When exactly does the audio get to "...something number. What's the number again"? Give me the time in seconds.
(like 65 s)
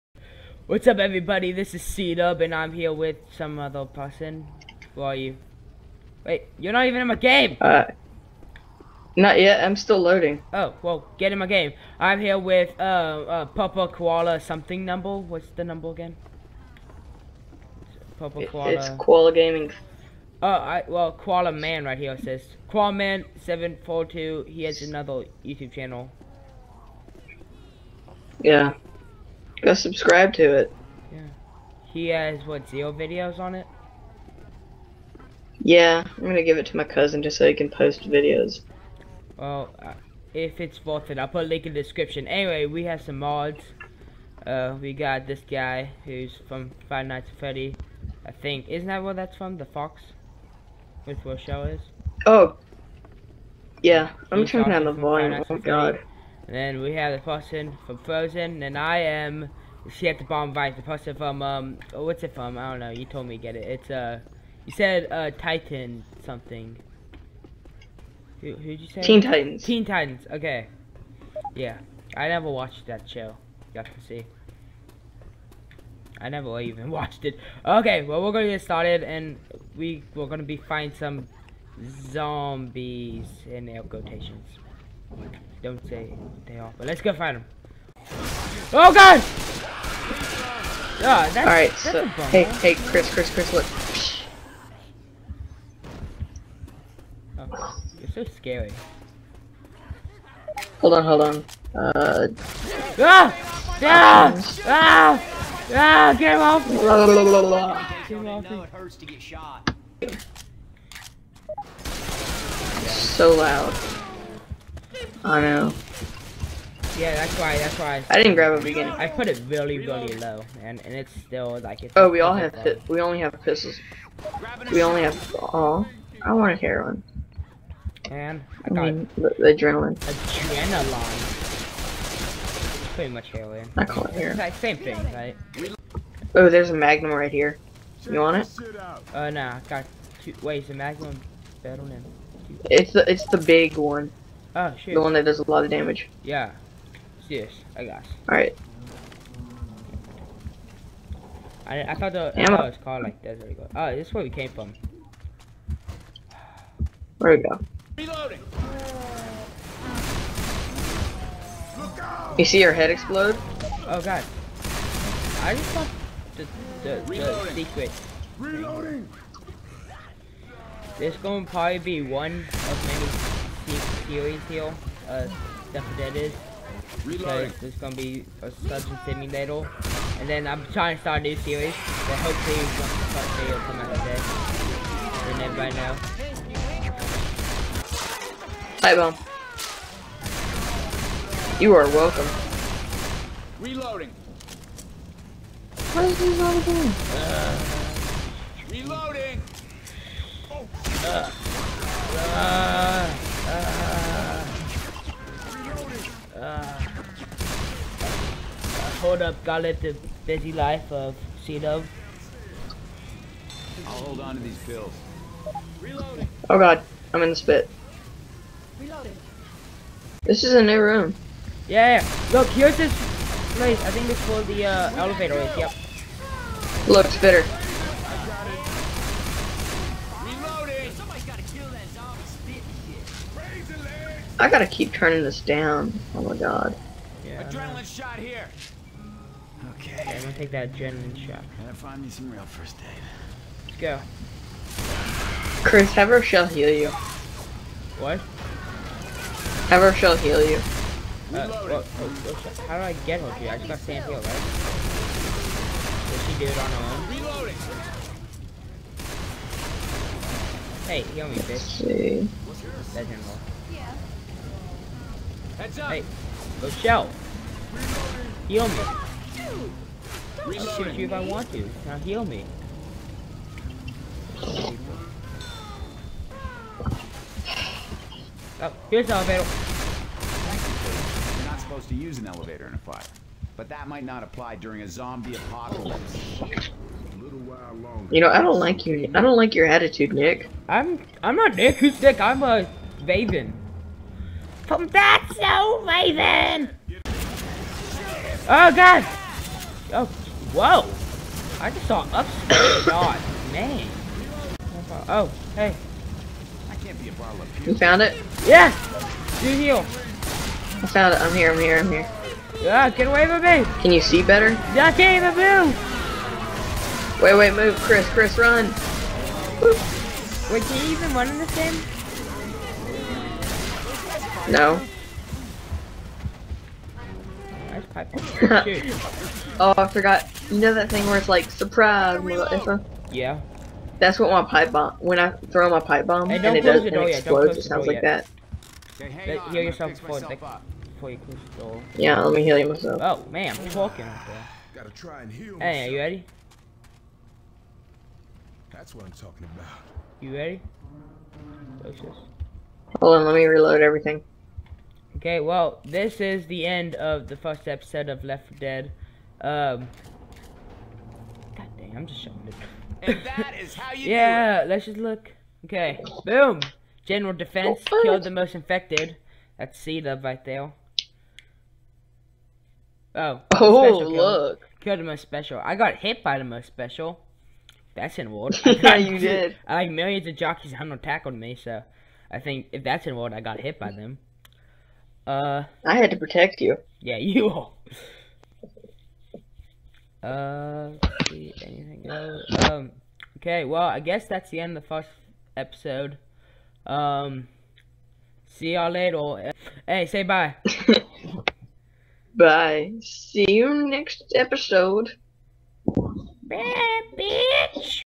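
14 s.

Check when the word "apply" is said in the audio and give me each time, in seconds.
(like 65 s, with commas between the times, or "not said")
284 s.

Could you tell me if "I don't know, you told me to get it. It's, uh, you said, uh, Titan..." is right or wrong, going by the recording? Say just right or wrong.
right.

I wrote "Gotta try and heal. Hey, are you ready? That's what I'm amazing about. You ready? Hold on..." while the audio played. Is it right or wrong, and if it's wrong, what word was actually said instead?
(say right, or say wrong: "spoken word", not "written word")
wrong: "talking", not "amazing".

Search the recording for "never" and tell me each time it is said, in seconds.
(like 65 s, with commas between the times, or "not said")
72 s, 76 s.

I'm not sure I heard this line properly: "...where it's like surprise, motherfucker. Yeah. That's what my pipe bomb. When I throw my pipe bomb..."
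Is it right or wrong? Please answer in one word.
right.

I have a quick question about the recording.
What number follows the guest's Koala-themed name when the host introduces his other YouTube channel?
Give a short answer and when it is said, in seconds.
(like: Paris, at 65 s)
742, at 23 s.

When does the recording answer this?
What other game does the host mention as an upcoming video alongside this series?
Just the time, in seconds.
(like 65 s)
178 s.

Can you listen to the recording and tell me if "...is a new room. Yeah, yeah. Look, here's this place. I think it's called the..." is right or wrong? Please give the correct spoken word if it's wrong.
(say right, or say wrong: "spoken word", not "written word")
right.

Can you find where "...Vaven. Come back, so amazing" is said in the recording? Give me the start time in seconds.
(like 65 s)
293 s.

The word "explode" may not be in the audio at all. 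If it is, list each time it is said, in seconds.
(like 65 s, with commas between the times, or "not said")
162 s, 337 s.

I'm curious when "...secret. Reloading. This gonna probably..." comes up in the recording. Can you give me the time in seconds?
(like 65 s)
167 s.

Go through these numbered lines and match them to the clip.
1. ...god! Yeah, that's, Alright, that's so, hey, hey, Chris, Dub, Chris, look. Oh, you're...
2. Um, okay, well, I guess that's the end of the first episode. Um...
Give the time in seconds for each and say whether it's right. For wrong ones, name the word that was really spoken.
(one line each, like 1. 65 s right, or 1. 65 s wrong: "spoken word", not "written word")
1. 88 s wrong: "Chris", not "Dub"
2. 392 s right.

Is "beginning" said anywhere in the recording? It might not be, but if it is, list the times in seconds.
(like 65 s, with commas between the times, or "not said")
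118 s.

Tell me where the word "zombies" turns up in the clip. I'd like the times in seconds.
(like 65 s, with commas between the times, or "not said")
82 s, 284 s.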